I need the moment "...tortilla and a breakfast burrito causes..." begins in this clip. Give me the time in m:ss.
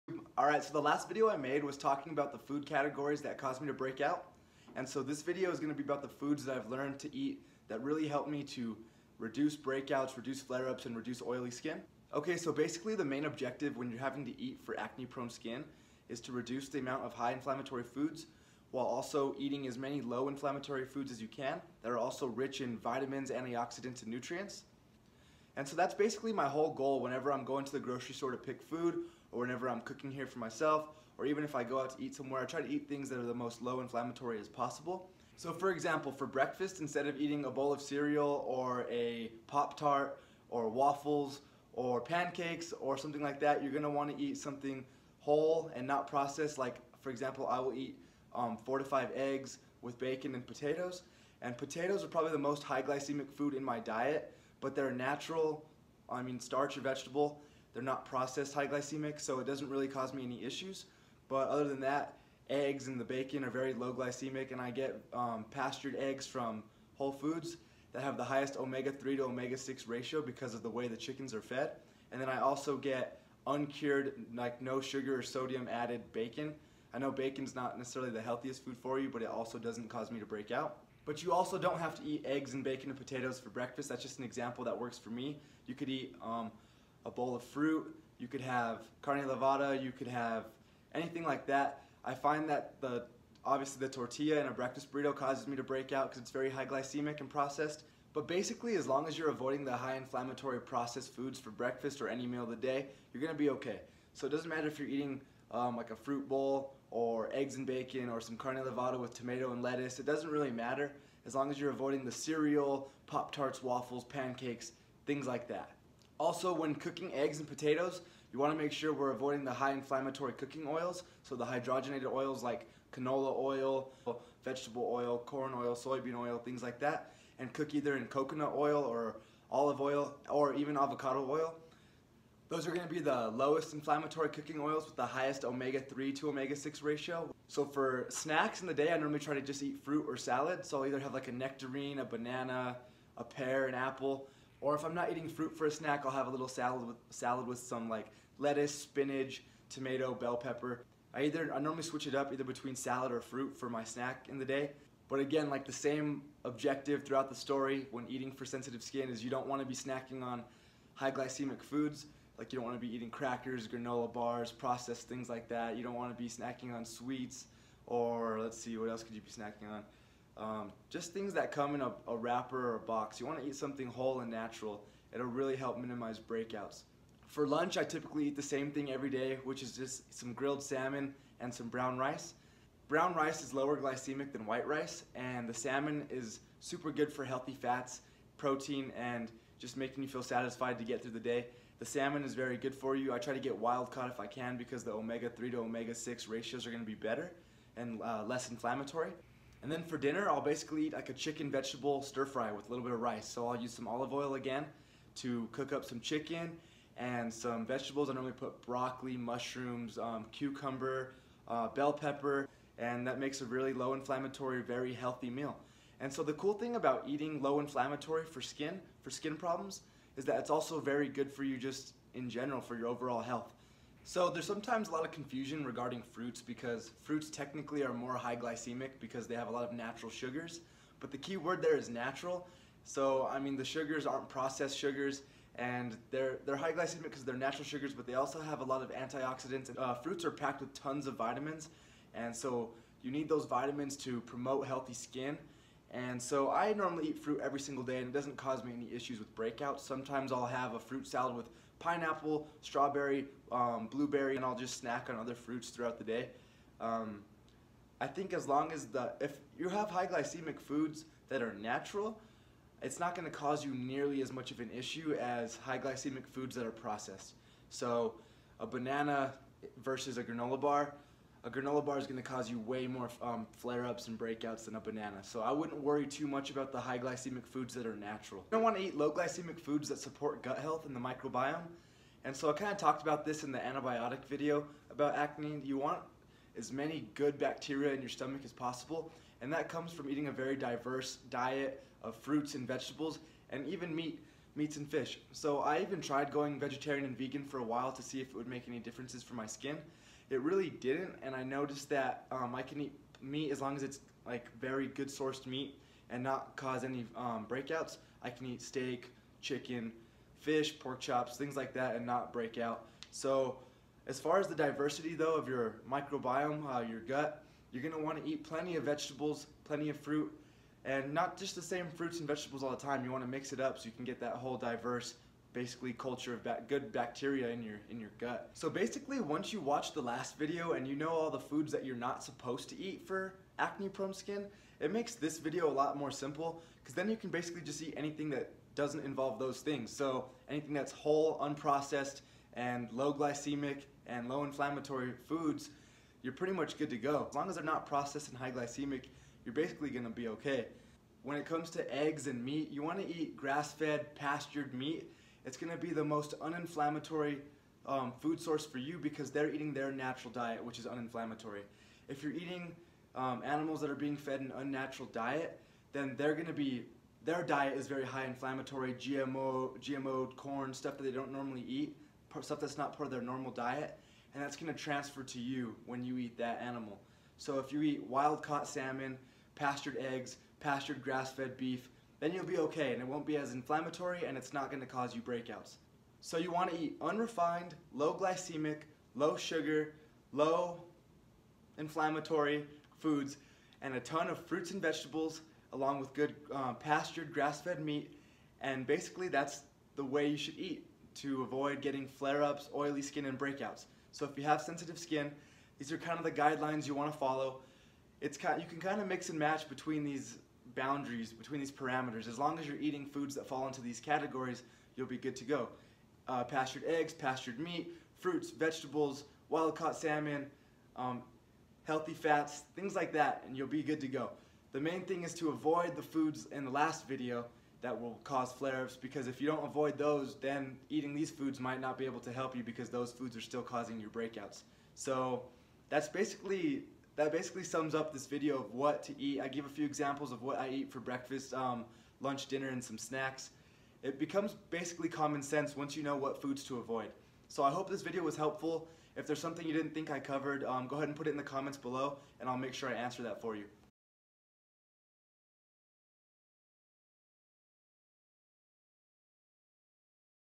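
1:33.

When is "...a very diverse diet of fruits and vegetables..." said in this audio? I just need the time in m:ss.
4:50.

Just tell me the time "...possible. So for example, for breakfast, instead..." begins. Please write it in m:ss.
0:34.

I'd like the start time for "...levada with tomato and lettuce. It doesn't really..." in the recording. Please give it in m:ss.
1:48.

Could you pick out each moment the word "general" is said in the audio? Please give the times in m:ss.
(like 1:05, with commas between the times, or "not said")
3:42.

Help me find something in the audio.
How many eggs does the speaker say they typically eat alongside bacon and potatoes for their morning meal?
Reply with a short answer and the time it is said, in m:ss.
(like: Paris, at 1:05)
4 to 5, at 0:48.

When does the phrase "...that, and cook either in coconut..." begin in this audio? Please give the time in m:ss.
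2:06.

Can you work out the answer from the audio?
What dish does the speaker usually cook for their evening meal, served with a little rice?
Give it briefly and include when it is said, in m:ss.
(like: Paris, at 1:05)
chicken vegetable stir fry, at 3:21.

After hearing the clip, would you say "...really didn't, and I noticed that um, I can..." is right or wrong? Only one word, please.
right.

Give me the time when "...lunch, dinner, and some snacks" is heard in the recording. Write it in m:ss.
7:22.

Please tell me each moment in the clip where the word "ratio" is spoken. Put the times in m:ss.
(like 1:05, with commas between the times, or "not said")
1:09, 2:16, 3:16.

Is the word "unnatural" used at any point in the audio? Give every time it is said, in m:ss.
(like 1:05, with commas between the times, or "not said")
6:04.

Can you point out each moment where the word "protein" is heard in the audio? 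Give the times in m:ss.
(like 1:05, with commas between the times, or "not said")
3:08.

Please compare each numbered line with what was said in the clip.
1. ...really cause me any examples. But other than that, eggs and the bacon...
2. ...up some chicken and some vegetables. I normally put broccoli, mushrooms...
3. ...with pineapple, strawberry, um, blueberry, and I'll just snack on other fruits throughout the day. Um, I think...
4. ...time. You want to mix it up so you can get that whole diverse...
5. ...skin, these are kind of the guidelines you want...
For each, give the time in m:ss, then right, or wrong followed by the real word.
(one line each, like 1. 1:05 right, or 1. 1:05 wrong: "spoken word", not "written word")
1. 0:59 wrong: "issues", not "examples"
2. 3:25 right
3. 4:11 right
4. 5:22 right
5. 6:44 right.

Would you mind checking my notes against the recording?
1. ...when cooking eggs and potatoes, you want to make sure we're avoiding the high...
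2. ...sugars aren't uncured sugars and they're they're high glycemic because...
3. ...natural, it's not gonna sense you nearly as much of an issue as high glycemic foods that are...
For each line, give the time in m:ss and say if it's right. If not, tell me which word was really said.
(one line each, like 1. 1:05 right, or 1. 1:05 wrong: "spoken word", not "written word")
1. 1:56 right
2. 3:53 wrong: "processed", not "uncured"
3. 4:21 wrong: "cause", not "sense".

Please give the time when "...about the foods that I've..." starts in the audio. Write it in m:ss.
0:05.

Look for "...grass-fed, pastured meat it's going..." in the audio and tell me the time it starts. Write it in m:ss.
5:53.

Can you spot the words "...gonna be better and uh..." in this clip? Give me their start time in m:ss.
3:16.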